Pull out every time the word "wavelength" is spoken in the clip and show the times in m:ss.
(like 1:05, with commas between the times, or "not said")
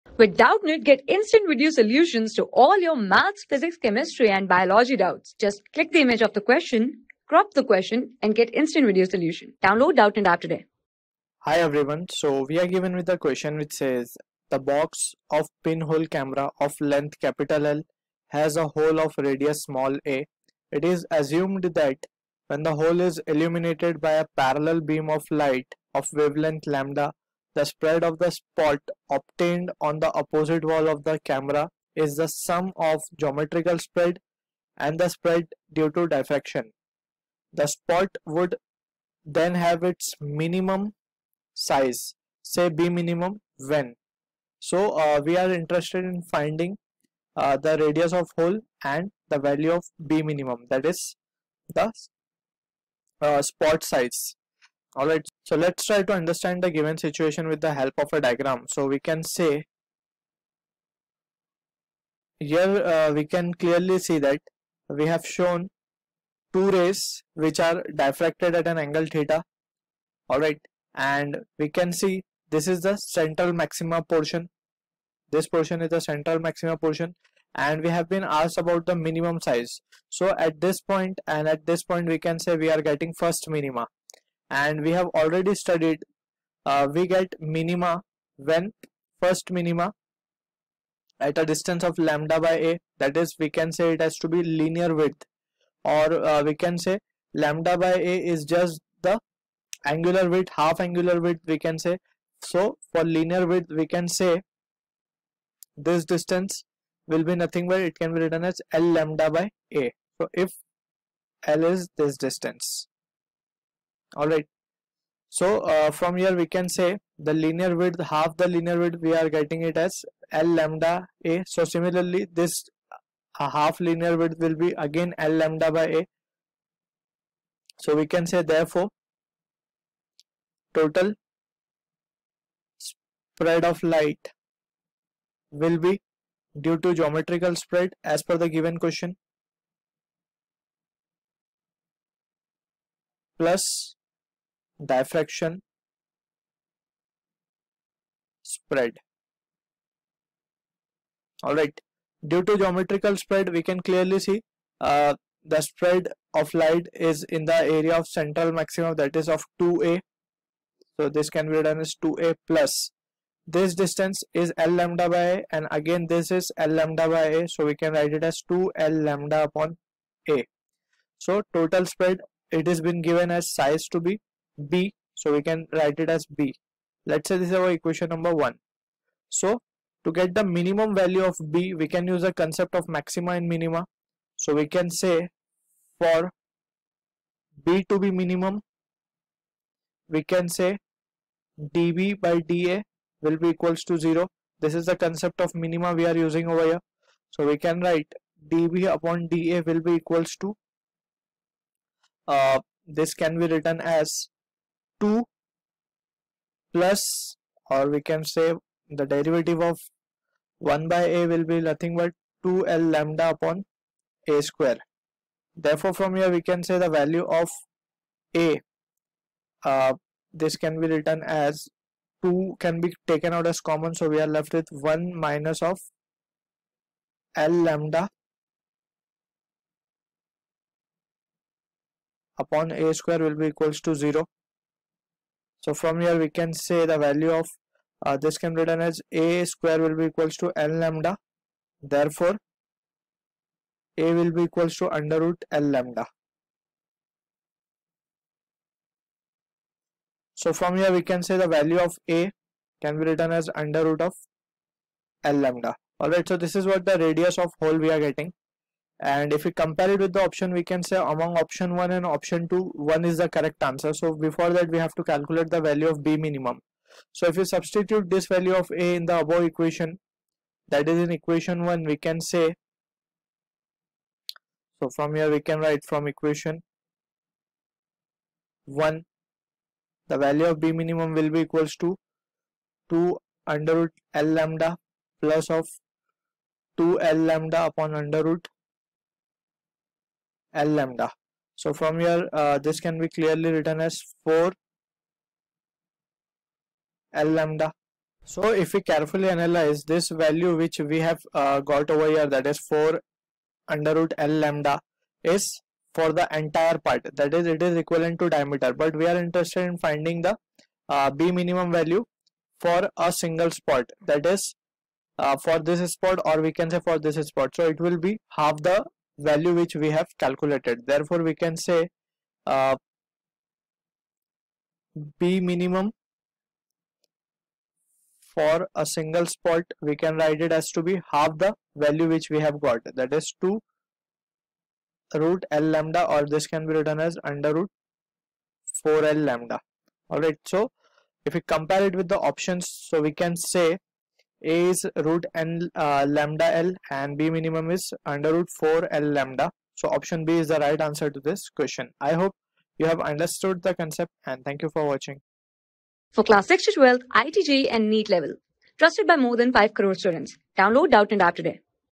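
0:26.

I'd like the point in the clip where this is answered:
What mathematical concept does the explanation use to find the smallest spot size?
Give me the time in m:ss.
3:02.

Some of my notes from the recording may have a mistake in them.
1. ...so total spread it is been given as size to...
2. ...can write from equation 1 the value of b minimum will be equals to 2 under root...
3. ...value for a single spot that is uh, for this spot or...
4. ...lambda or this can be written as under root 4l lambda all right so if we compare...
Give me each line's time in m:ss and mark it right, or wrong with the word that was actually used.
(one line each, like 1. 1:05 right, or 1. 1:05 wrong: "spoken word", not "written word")
1. 2:51 right
2. 4:35 right
3. 5:11 right
4. 5:35 right.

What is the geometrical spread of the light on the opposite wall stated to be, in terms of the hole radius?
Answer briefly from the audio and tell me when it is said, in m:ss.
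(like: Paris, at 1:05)
2a, at 2:38.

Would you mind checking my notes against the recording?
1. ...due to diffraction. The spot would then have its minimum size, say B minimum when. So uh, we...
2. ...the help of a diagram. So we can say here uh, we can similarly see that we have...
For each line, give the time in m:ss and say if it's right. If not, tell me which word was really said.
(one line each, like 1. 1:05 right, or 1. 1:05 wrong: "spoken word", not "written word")
1. 0:35 right
2. 0:57 wrong: "clearly", not "similarly".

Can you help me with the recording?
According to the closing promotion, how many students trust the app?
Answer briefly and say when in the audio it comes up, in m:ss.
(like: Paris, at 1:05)
more than 5 crore, at 5:59.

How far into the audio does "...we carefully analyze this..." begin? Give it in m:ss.
4:58.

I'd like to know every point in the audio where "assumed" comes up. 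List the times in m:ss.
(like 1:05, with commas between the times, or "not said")
0:21.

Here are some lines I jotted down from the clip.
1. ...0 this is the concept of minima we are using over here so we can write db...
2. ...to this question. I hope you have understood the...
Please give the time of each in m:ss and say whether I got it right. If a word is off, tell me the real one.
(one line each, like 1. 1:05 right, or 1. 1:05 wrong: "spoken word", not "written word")
1. 3:13 right
2. 5:51 right.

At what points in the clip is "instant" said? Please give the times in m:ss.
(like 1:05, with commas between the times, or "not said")
0:01, 0:08.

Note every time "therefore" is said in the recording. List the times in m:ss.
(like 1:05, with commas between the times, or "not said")
2:08, 3:35, 4:01, 5:20.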